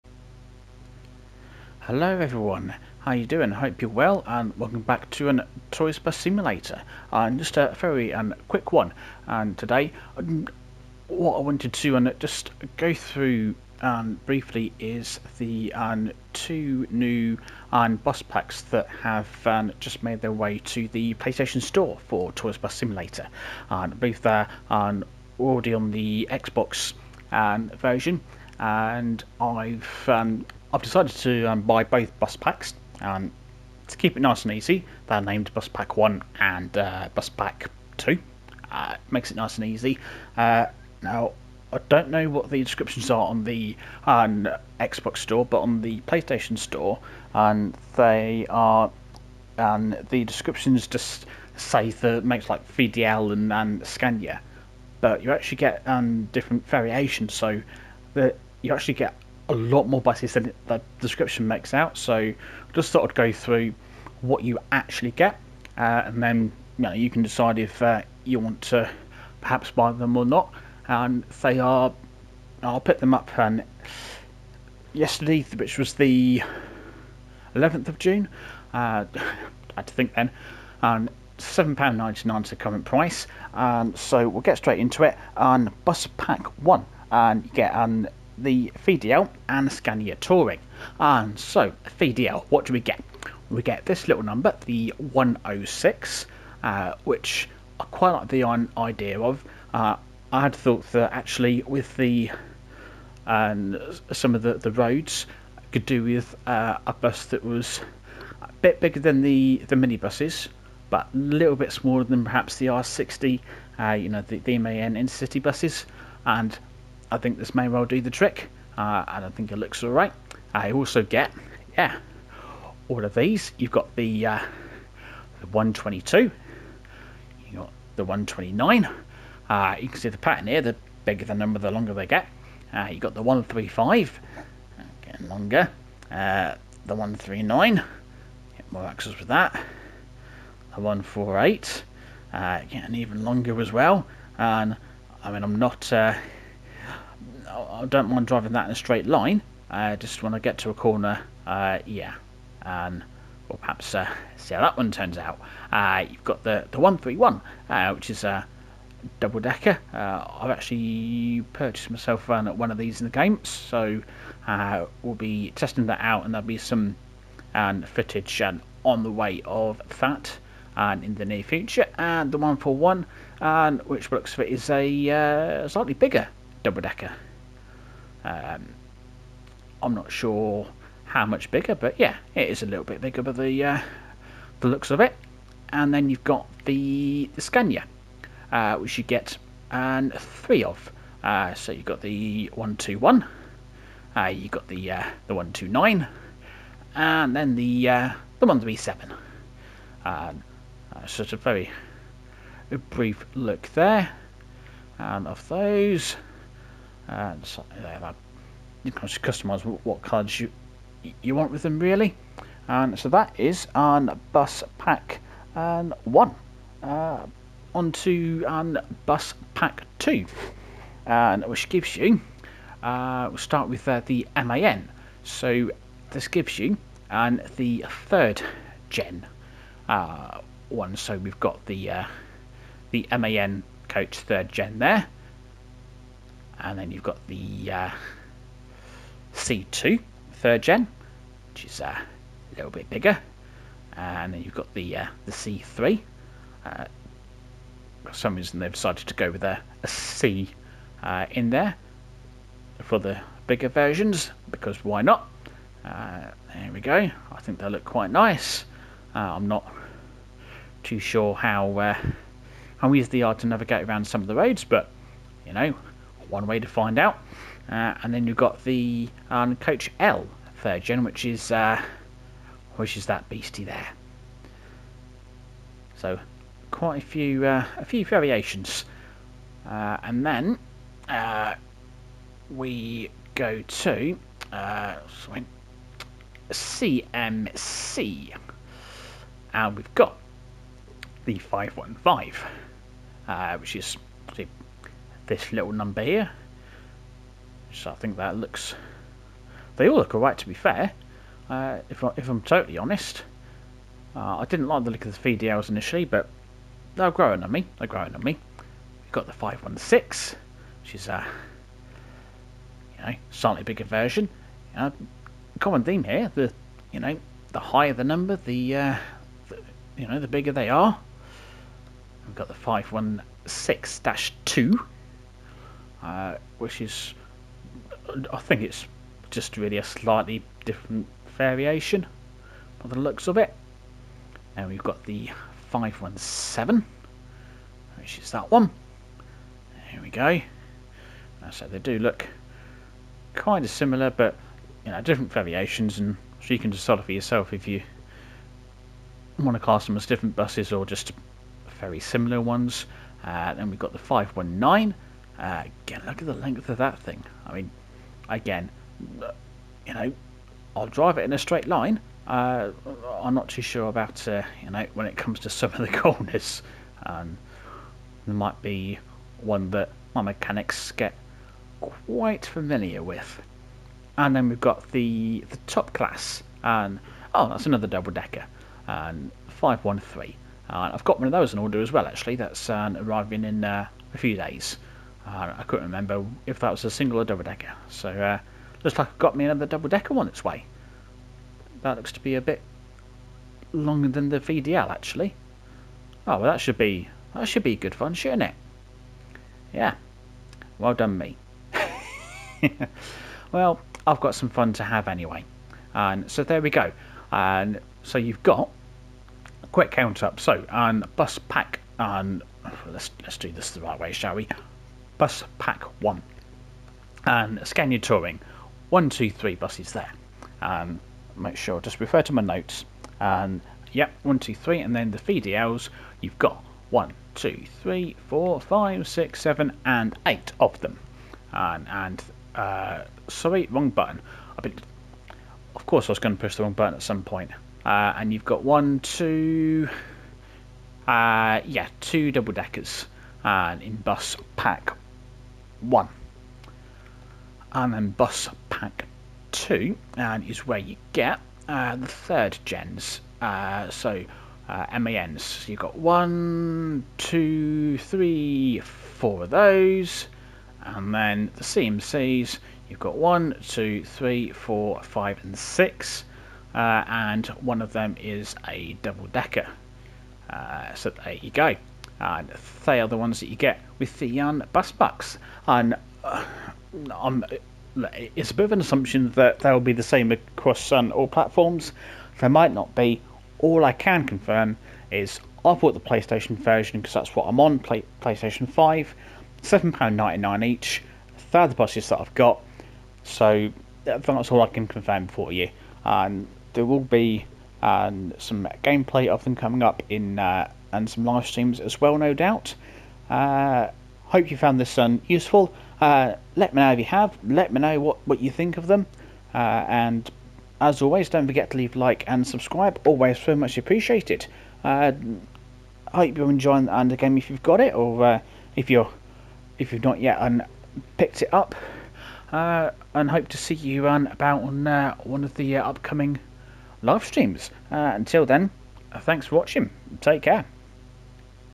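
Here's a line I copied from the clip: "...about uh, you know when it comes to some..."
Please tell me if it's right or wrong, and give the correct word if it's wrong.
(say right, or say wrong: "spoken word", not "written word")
right.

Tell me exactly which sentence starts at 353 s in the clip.
Uh, then we've got the 519, again, look at the length of that thing.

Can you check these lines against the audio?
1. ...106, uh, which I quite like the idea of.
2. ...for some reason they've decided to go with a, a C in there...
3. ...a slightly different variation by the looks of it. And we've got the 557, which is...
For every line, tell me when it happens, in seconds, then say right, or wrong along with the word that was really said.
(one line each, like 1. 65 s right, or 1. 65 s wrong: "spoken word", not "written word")
1. 94 s right
2. 248 s right
3. 329 s wrong: "517", not "557".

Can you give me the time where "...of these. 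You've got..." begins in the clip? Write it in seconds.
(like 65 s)
123 s.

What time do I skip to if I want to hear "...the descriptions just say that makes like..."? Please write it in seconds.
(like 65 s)
50 s.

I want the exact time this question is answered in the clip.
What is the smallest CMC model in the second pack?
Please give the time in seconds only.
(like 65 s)
291 s.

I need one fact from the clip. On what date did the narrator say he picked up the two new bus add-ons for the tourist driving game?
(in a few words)
11th of June.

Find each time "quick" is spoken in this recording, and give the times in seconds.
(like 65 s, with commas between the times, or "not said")
8 s, 409 s.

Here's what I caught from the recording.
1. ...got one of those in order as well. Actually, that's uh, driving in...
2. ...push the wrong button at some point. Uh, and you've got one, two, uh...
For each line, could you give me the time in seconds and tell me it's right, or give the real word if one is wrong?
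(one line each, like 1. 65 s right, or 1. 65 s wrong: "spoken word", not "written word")
1. 381 s wrong: "arriving", not "driving"
2. 436 s right.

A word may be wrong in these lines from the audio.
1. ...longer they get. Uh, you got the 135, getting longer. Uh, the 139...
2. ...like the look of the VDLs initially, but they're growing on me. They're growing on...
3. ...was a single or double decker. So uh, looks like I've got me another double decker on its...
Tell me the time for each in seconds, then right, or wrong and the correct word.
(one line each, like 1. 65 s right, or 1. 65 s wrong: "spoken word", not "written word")
1. 131 s right
2. 304 s right
3. 386 s right.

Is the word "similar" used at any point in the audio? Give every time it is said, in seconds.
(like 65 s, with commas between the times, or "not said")
343 s, 351 s.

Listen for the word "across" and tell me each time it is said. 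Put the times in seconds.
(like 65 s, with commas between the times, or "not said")
480 s.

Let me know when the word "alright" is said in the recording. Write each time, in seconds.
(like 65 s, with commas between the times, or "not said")
119 s, 300 s.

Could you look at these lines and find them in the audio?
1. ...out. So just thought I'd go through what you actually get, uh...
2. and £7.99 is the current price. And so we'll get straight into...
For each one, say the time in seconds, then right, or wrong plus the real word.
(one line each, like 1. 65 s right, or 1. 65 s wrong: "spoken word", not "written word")
1. 61 s right
2. 80 s right.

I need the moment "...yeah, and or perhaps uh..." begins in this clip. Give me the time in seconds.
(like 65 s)
151 s.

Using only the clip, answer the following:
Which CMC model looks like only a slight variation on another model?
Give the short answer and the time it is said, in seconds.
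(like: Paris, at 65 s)
516-2, at 323 s.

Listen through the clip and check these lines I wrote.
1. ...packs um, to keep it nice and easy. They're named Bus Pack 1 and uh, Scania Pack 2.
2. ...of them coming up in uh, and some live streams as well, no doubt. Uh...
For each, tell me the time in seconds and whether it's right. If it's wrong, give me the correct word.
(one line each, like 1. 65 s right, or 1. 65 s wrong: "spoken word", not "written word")
1. 32 s wrong: "Bus", not "Scania"
2. 499 s right.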